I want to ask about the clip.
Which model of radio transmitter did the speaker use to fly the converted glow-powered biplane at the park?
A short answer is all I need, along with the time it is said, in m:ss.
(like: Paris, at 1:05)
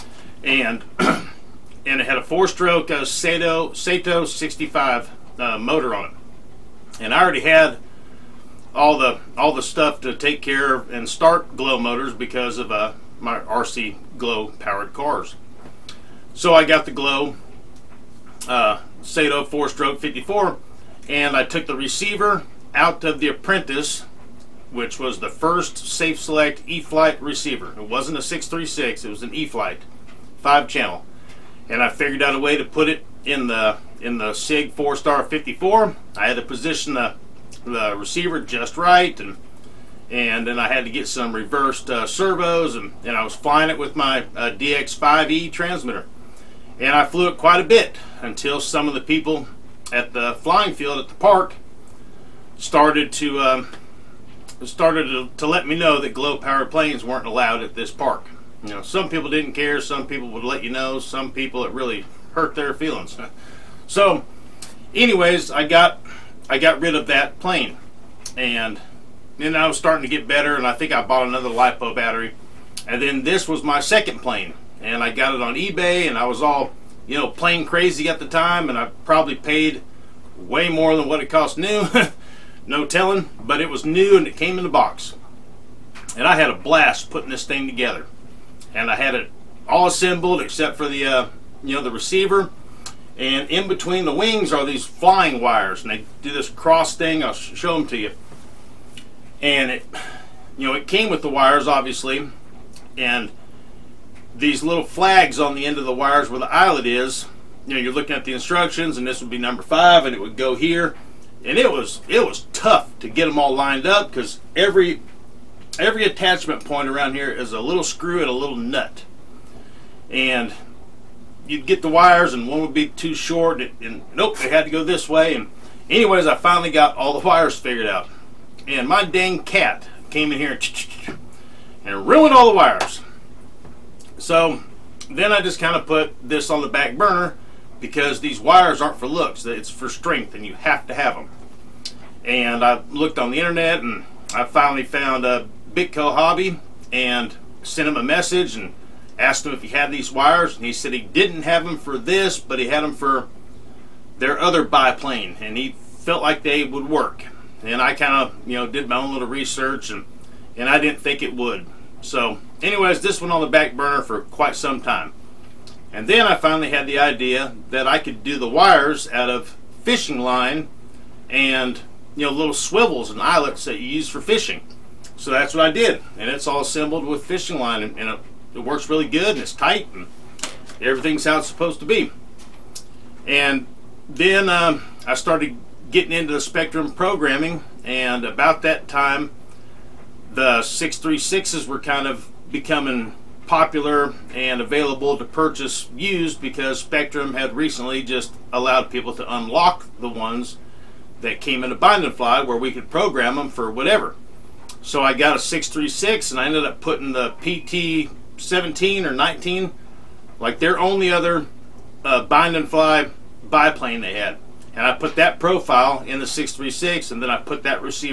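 DX5E, at 0:44.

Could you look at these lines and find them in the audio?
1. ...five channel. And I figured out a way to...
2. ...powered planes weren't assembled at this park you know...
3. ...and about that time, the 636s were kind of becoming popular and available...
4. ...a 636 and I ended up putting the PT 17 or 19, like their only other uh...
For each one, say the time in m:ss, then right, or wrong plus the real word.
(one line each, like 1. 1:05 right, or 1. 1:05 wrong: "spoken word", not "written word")
1. 0:30 right
2. 0:56 wrong: "allowed", not "assembled"
3. 3:07 right
4. 3:25 right.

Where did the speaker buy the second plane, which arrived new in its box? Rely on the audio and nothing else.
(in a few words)
eBay.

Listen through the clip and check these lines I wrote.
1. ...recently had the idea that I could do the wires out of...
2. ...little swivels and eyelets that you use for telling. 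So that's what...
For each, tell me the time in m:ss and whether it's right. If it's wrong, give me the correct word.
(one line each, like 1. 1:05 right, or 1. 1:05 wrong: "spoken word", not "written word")
1. 2:46 wrong: "finally", not "recently"
2. 2:52 wrong: "fishing", not "telling".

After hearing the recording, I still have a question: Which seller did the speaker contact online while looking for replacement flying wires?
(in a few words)
Bitco Hobby.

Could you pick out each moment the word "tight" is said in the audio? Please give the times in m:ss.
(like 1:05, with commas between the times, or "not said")
2:59.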